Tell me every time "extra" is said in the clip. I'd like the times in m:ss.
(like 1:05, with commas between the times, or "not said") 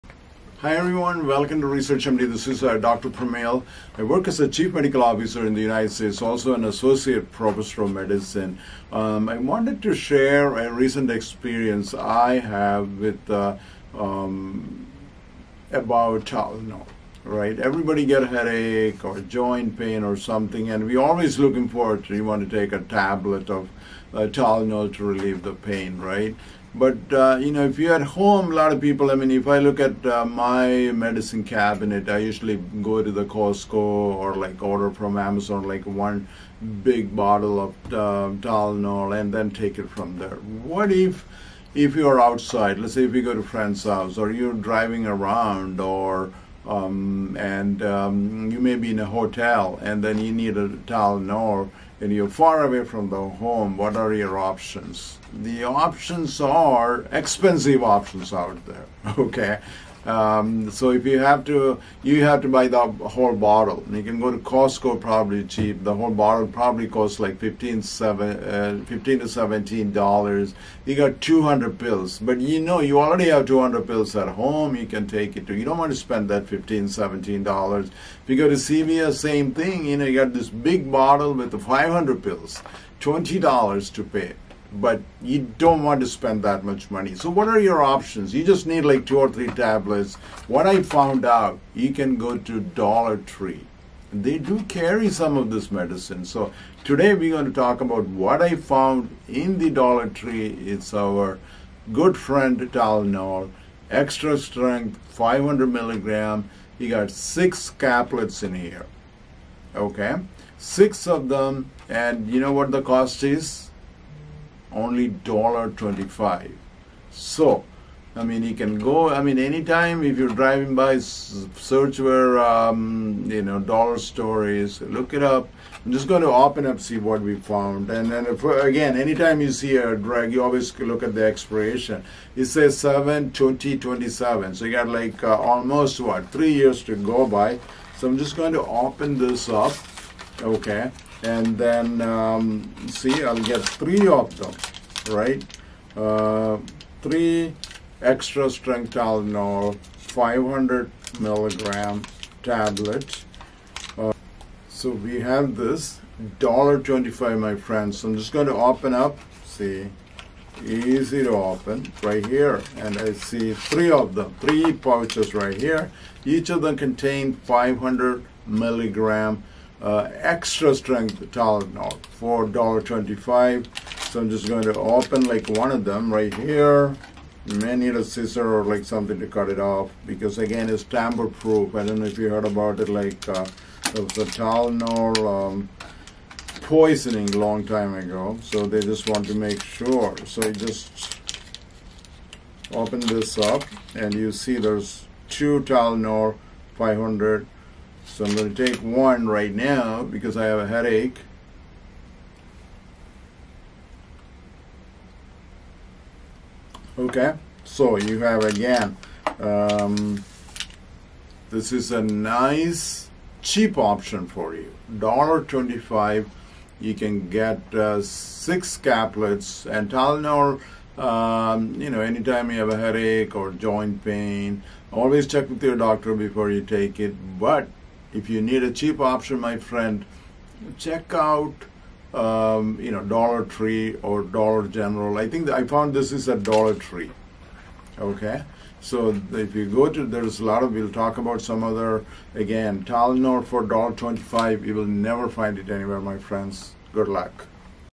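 1:43, 2:28, 2:50.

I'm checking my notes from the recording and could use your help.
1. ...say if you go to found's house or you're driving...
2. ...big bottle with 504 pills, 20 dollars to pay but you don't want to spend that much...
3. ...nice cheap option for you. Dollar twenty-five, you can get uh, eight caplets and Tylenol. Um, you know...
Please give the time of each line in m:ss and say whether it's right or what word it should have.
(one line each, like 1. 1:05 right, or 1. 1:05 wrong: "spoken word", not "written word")
1. 0:42 wrong: "friend", not "found"
2. 1:20 wrong: "500", not "504"
3. 3:32 wrong: "six", not "eight".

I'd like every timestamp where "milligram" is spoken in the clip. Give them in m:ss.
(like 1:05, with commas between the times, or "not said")
1:45, 2:31, 2:48.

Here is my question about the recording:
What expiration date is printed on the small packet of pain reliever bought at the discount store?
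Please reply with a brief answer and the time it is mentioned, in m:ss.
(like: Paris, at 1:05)
7/20/27, at 2:12.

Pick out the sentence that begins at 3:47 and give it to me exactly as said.
But if you need a cheap option, my friend, check out um, you know, Dollar Tree or Dollar General.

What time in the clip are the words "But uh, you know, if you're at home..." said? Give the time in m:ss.
0:26.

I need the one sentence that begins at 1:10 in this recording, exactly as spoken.
You got 200 pills, but you know you already have 200 pills at home.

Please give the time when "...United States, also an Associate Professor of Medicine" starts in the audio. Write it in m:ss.
0:05.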